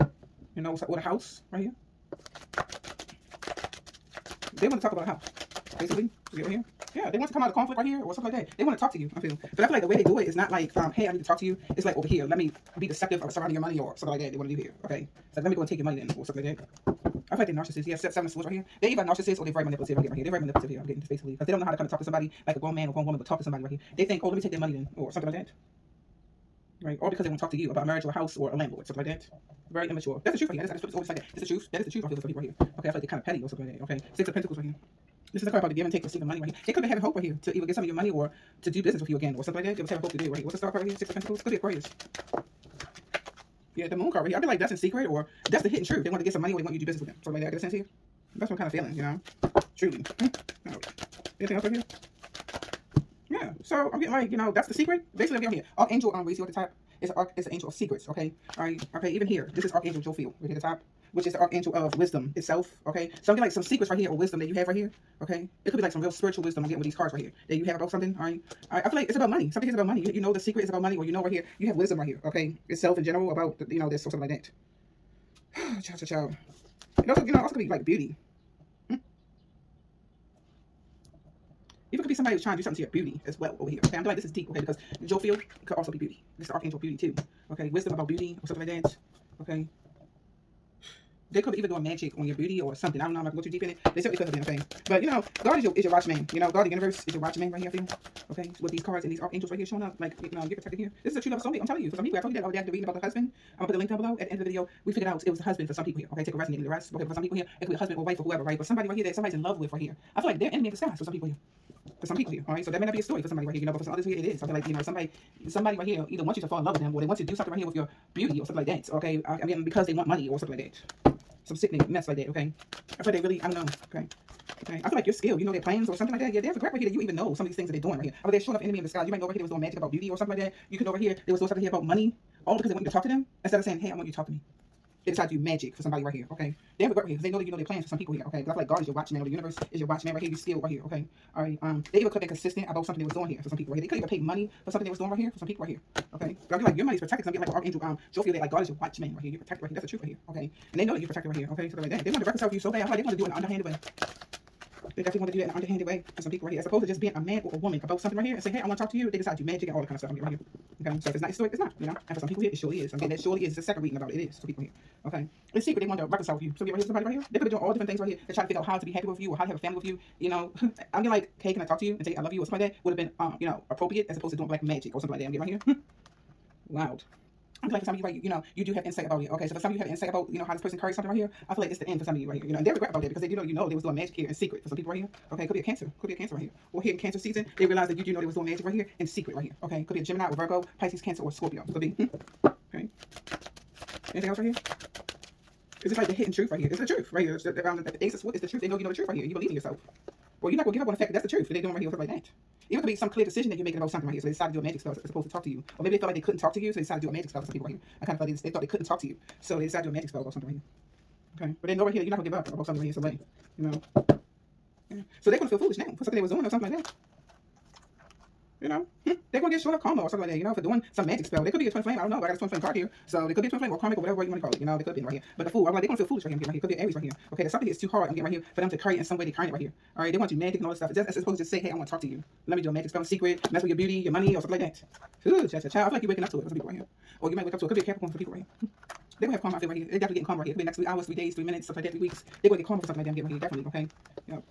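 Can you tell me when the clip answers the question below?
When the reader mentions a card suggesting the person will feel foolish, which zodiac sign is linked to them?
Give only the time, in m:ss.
3:46.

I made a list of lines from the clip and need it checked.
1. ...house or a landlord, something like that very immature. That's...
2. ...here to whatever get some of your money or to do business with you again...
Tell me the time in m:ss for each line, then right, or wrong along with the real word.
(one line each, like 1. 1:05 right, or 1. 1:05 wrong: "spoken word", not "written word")
1. 0:28 right
2. 0:37 wrong: "either", not "whatever".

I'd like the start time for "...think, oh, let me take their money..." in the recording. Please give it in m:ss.
0:24.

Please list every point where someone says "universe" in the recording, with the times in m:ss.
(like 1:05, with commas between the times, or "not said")
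1:36, 2:19.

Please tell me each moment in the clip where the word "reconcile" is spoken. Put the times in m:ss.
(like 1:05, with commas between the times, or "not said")
2:32, 2:46.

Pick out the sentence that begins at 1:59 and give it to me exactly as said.
I mean, because they want money or something like that.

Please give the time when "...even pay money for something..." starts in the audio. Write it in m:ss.
2:23.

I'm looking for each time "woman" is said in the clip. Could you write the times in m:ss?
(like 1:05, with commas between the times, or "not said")
0:23, 2:37.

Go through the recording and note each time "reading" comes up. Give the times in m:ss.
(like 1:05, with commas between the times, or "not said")
1:42, 2:43.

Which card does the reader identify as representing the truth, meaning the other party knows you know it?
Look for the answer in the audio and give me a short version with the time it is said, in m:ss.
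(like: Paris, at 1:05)
Ace of Swords, at 3:18.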